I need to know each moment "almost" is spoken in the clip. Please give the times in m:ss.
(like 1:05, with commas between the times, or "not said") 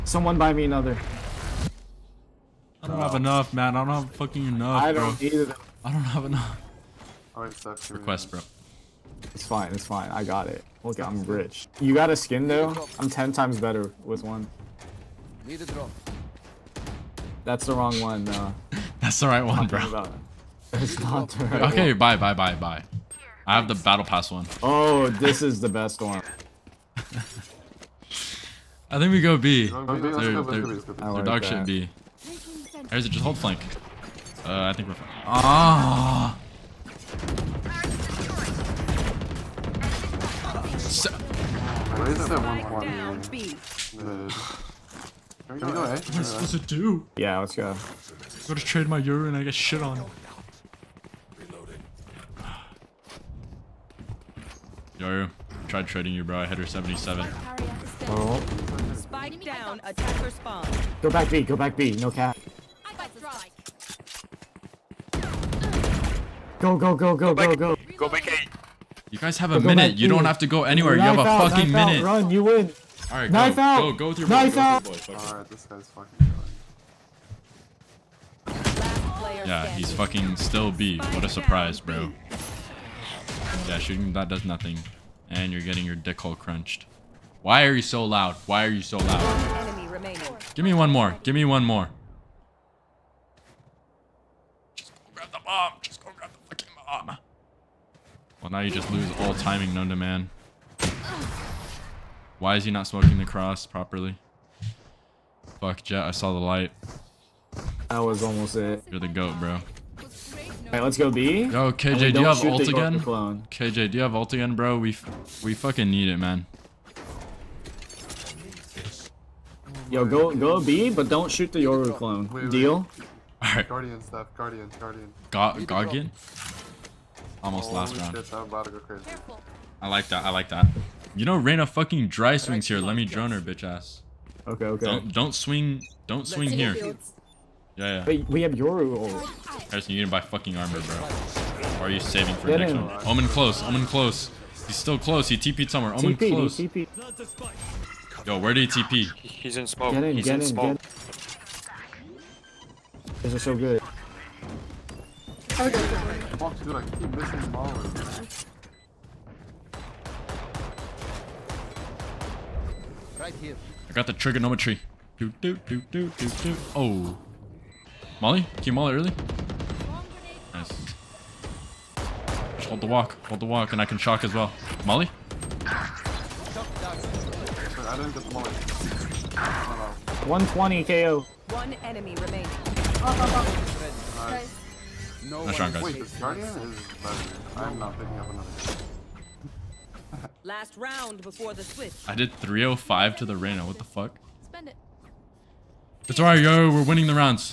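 1:48, 2:07.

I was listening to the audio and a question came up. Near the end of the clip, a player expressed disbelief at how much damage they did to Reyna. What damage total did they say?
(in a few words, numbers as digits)
305.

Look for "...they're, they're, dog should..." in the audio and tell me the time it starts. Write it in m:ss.
0:29.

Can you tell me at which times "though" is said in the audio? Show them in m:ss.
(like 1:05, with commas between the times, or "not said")
0:12.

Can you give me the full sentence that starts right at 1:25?
And you're getting your dick hole crunched.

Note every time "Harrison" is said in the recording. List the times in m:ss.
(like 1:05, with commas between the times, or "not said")
2:19.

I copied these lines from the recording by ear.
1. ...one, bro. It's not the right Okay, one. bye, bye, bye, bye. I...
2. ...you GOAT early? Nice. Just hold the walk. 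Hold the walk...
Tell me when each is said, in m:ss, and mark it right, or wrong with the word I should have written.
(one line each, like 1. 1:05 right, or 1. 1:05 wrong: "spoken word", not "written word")
1. 0:19 right
2. 2:48 wrong: "Molly", not "GOAT".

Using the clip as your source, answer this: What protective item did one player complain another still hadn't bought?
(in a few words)
armor.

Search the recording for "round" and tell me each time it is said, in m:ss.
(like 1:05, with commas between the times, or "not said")
2:08, 3:10.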